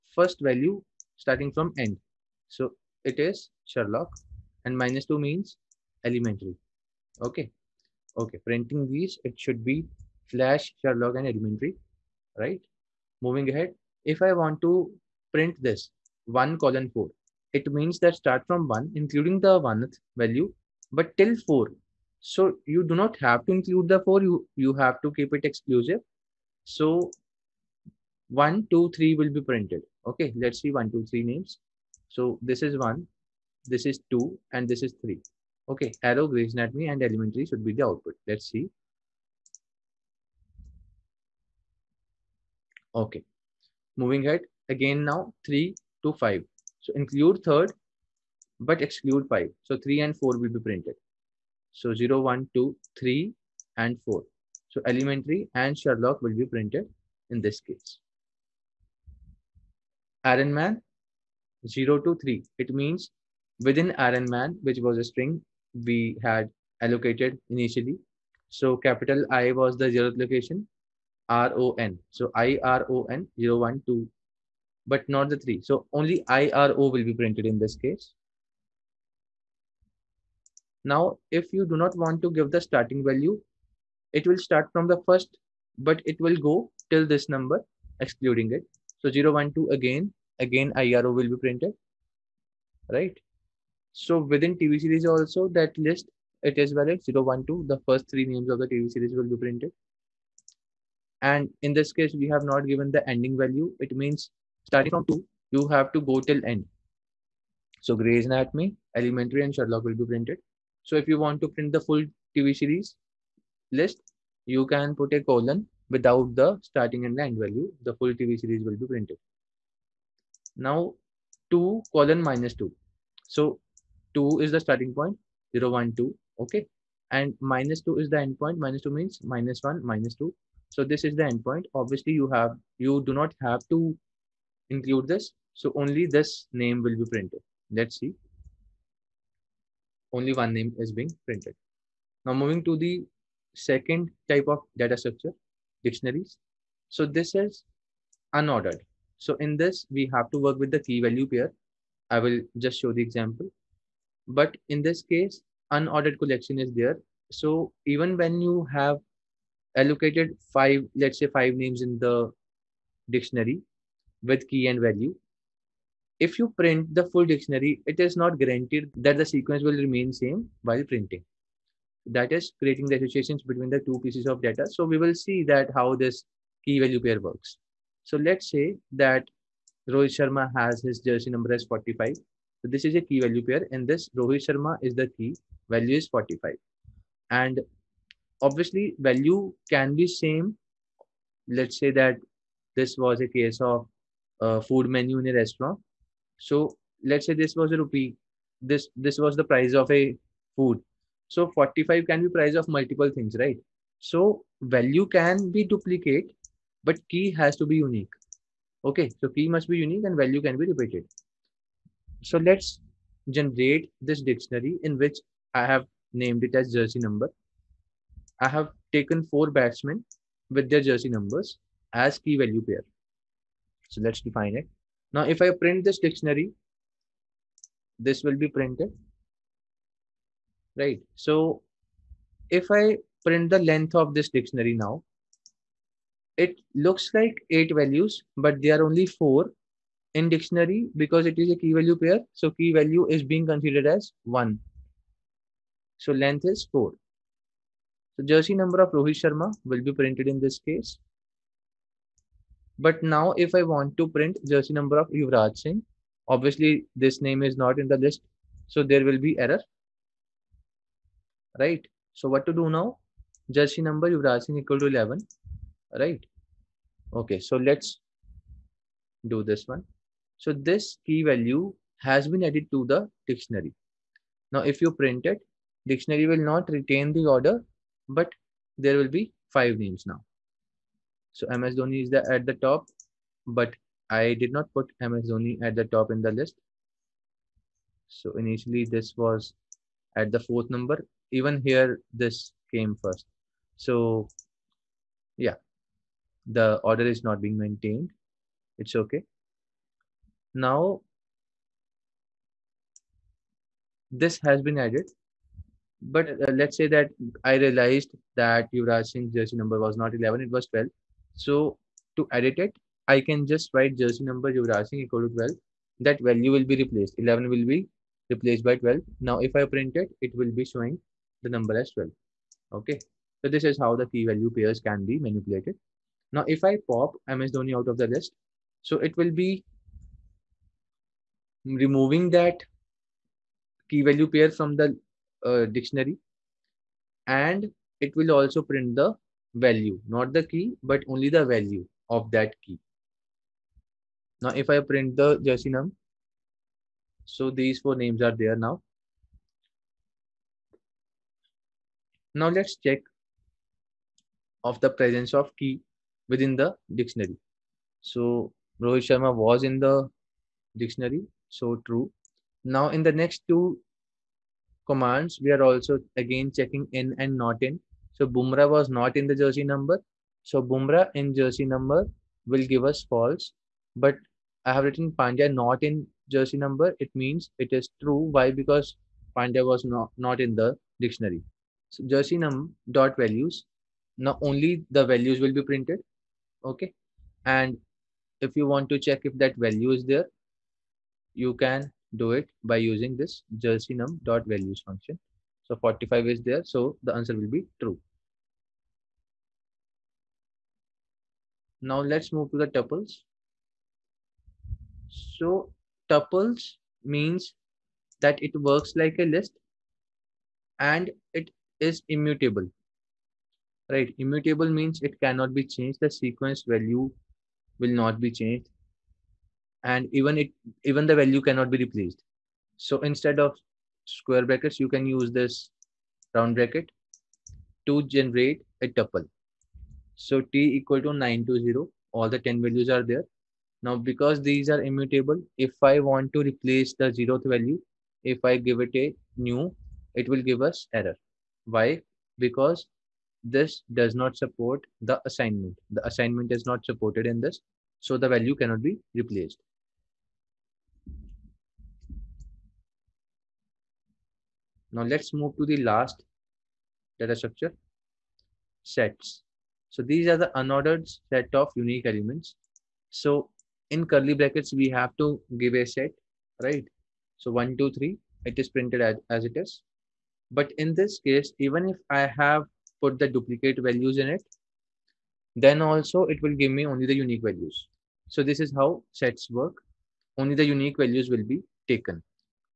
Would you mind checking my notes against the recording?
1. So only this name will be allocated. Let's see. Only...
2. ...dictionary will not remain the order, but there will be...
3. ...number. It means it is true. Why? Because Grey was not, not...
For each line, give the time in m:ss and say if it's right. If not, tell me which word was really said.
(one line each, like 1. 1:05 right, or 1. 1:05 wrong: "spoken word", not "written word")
1. 2:15 wrong: "printed", not "allocated"
2. 4:35 wrong: "retain", not "remain"
3. 6:16 wrong: "Pandya", not "Grey".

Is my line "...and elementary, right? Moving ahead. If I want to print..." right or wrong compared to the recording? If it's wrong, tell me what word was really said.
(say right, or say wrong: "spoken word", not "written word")
right.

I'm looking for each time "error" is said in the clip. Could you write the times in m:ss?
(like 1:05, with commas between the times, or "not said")
4:19, 7:21.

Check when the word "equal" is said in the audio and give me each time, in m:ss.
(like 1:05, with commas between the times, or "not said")
4:24, 5:14, 7:10.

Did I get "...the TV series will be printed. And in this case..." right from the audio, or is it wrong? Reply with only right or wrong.
right.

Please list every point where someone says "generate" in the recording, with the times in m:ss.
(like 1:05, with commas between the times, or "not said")
3:33, 7:08.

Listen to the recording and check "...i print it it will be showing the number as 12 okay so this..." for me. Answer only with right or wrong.
right.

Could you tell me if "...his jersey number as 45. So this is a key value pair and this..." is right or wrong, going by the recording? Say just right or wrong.
right.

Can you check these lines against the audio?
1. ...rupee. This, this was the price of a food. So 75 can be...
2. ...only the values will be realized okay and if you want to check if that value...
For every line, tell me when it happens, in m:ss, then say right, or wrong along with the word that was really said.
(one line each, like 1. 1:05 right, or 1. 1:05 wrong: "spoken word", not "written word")
1. 3:17 wrong: "45", not "75"
2. 6:24 wrong: "printed", not "realized".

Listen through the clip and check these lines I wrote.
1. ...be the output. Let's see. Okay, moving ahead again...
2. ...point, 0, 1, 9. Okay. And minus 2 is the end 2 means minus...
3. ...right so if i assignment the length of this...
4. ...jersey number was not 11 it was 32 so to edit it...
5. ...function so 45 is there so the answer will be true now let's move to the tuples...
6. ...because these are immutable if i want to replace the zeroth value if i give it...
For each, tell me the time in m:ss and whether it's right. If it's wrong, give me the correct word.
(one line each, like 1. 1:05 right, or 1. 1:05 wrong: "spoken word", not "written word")
1. 0:37 right
2. 2:04 wrong: "2", not "9"
3. 3:50 wrong: "print", not "assignment"
4. 5:09 wrong: "12", not "32"
5. 6:34 right
6. 7:13 right.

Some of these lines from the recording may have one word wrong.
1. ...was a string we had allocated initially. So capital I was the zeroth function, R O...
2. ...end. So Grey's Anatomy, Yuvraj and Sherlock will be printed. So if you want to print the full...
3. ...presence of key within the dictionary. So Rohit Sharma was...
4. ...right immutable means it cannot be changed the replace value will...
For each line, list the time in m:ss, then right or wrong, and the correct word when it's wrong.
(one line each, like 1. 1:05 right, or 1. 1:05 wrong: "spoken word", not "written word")
1. 1:04 wrong: "location", not "function"
2. 1:46 wrong: "Elementary", not "Yuvraj"
3. 5:54 right
4. 6:53 wrong: "sequence", not "replace".